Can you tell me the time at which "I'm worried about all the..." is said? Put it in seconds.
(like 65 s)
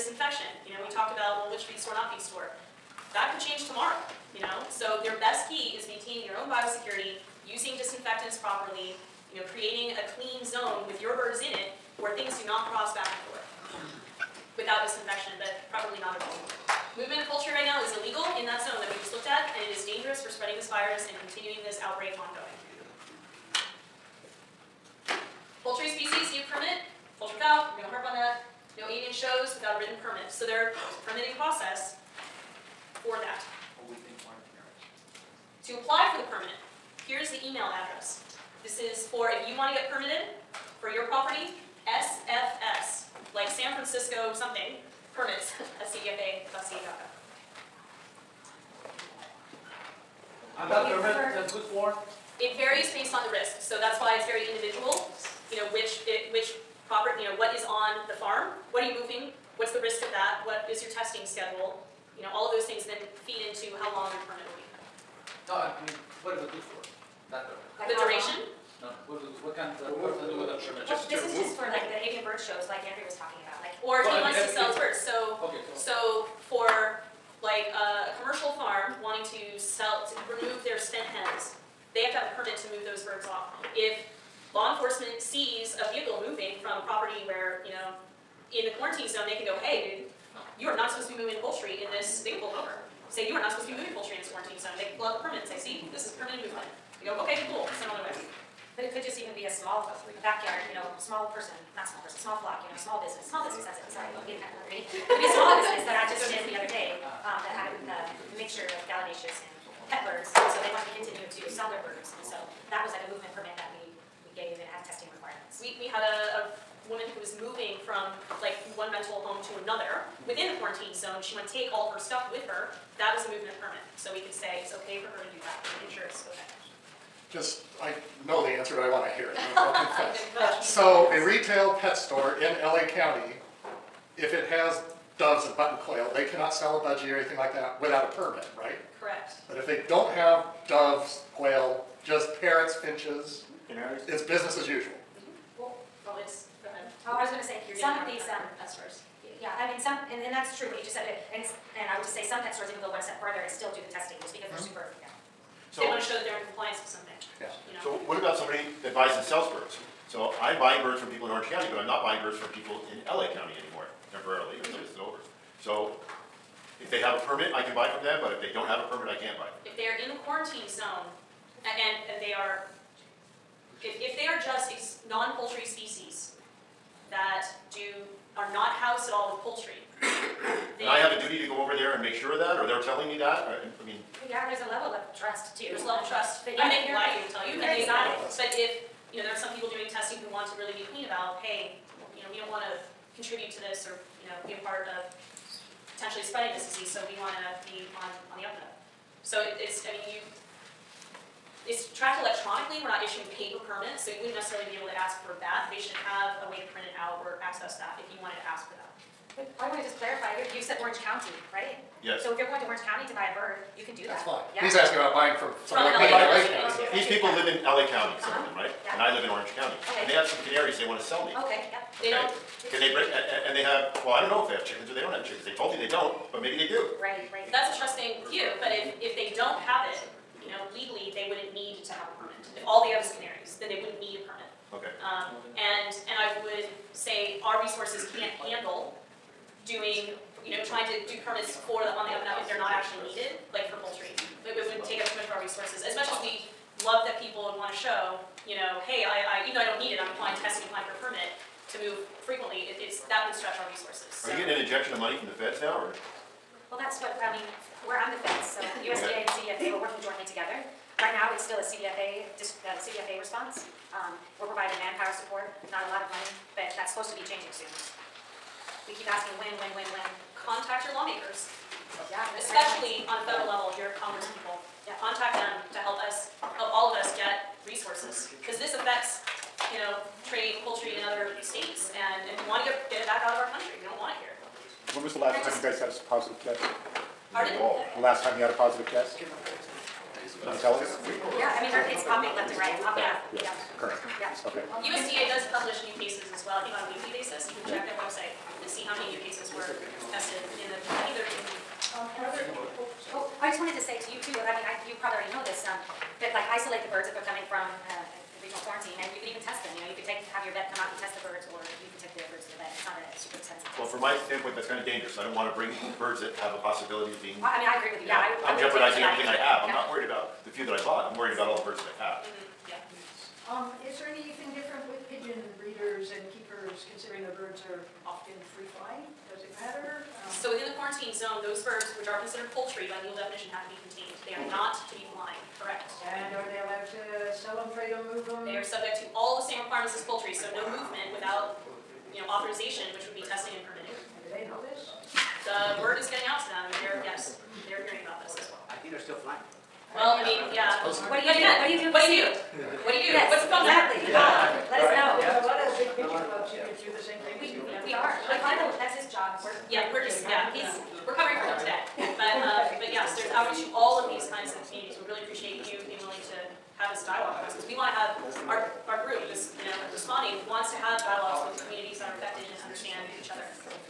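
321 s.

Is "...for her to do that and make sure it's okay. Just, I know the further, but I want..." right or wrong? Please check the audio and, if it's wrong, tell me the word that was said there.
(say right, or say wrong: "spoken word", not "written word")
wrong: "answer", not "further".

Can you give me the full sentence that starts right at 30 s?
So there's permitting process for that.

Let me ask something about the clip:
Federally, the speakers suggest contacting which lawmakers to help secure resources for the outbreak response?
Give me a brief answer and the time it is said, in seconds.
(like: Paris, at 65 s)
Congress people, at 273 s.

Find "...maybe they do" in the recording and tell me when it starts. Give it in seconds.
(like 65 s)
226 s.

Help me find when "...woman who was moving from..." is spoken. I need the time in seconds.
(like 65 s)
116 s.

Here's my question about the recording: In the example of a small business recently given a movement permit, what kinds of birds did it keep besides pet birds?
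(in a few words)
gallinaceous.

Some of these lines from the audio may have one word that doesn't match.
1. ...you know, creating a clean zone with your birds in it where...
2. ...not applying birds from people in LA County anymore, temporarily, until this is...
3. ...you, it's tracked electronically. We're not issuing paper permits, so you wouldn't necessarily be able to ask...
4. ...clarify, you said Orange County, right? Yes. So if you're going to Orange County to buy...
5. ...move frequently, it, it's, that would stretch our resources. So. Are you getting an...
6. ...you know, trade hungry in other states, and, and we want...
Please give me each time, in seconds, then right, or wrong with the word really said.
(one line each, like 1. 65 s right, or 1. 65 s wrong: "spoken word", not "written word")
1. 9 s right
2. 161 s wrong: "buying", not "applying"
3. 200 s right
4. 209 s right
5. 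251 s right
6. 279 s wrong: "poultry", not "hungry".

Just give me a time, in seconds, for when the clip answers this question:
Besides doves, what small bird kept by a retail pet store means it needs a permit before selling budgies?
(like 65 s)
135 s.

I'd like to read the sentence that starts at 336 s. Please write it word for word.
And are they allowed to sell them, trade them, move them?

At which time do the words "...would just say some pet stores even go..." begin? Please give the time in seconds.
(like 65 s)
151 s.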